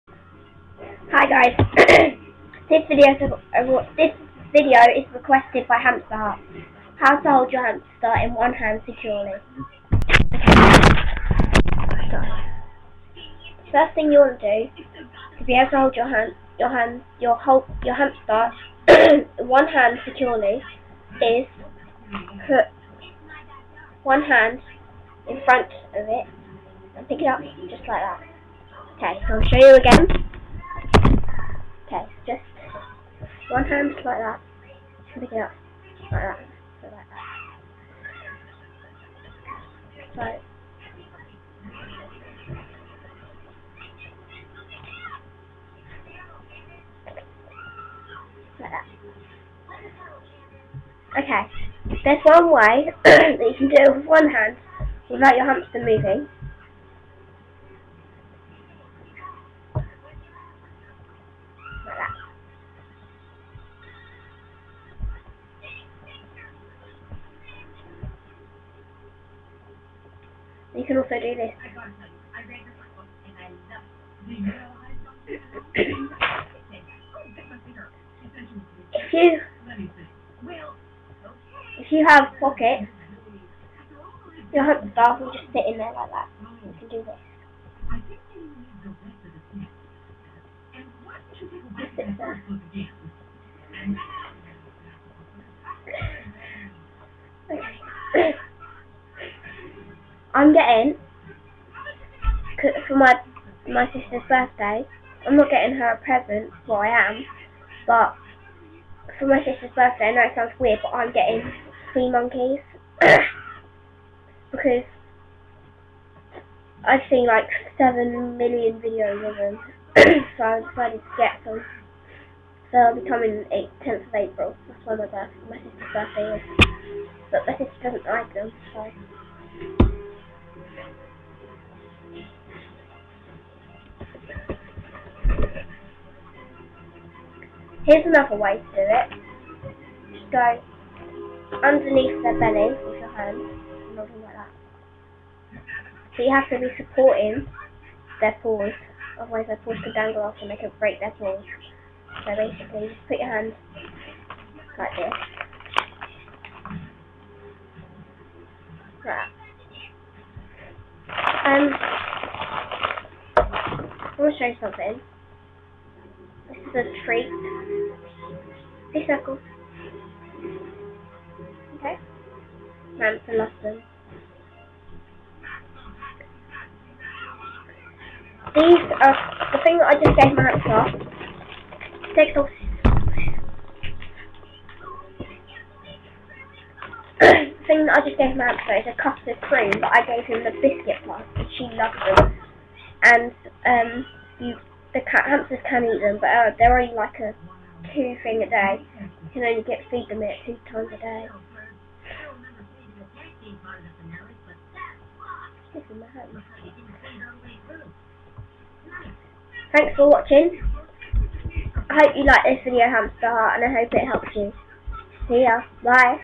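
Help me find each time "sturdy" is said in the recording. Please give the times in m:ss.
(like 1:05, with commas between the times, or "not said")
not said.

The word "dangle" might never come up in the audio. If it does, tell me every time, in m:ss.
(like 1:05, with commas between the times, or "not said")
2:29.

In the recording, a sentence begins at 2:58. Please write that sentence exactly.
These are the thing that I just gave my hands off.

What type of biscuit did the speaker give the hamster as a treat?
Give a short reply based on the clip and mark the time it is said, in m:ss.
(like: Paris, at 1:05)
custard cream, at 3:09.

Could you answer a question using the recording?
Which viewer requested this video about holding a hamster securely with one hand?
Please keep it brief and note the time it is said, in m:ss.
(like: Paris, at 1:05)
Hamster Heart, at 0:05.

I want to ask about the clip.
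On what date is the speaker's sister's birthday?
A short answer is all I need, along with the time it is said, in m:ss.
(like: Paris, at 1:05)
10th of April, at 2:03.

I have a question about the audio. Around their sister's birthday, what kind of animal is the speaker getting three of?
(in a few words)
monkeys.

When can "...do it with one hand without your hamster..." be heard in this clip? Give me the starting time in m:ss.
0:53.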